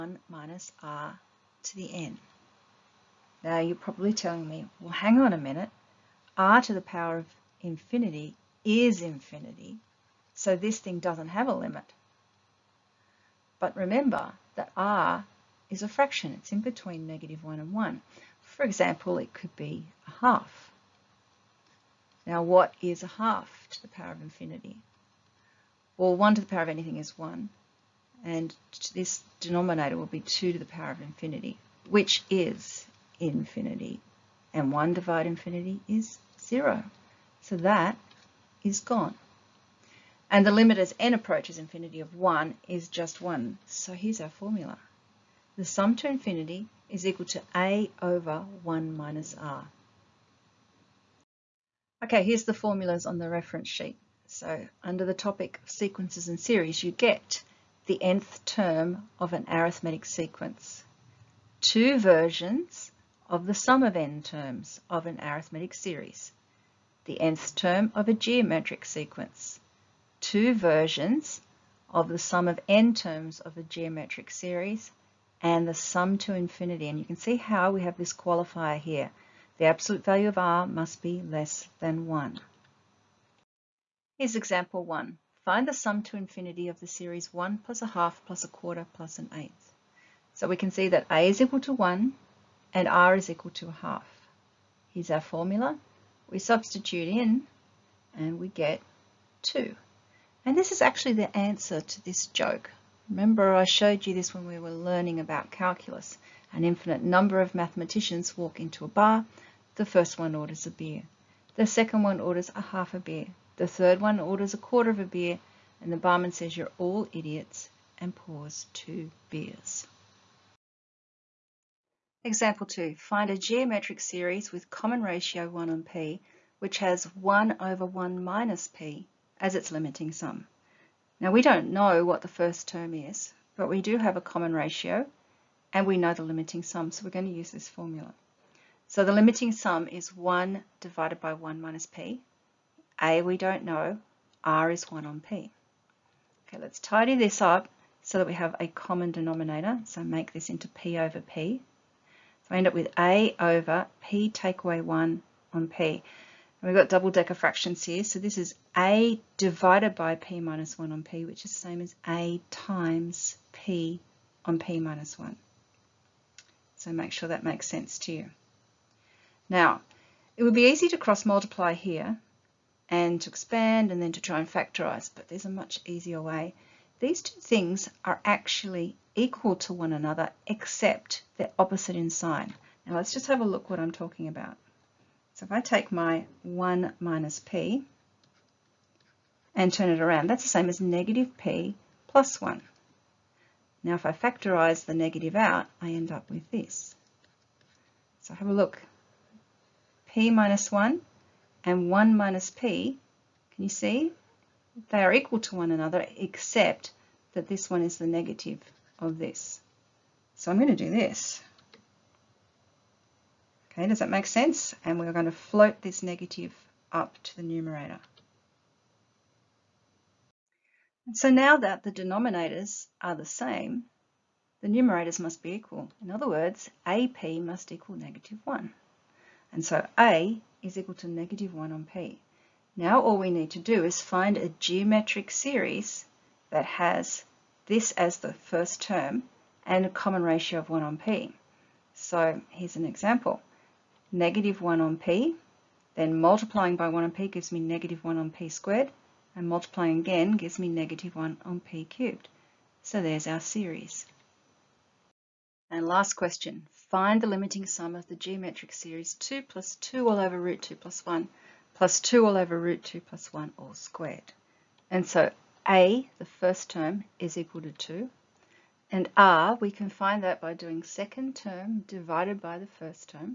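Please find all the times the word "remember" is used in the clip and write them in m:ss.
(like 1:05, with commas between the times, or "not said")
0:13, 1:43.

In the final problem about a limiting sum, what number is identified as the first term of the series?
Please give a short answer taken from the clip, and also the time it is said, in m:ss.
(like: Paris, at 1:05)
2, at 4:27.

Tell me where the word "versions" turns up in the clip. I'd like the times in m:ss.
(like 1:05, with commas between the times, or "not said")
1:01, 1:10.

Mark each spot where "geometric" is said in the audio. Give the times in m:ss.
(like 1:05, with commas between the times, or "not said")
1:08, 1:13, 2:03, 3:54, 4:18.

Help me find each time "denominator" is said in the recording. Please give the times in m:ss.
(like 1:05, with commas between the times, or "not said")
0:29, 2:29, 3:41.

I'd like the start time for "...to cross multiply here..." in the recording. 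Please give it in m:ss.
2:50.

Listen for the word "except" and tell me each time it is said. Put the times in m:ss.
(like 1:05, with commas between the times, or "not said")
3:00, 3:26.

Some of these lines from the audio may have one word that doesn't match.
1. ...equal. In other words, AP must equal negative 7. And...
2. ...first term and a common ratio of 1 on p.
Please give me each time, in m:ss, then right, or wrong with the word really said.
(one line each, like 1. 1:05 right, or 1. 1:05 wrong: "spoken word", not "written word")
1. 3:45 wrong: "1", not "7"
2. 3:58 right.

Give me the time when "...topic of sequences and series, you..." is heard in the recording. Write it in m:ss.
0:55.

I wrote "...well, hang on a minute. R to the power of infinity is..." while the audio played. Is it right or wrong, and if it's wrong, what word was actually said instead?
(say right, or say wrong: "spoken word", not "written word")
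right.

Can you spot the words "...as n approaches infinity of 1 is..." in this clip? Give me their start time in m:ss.
0:40.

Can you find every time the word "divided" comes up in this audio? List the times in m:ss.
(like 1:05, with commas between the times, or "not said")
0:34, 2:20, 2:39, 4:31.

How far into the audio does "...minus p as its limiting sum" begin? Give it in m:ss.
2:08.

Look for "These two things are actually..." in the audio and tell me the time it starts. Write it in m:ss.
2:56.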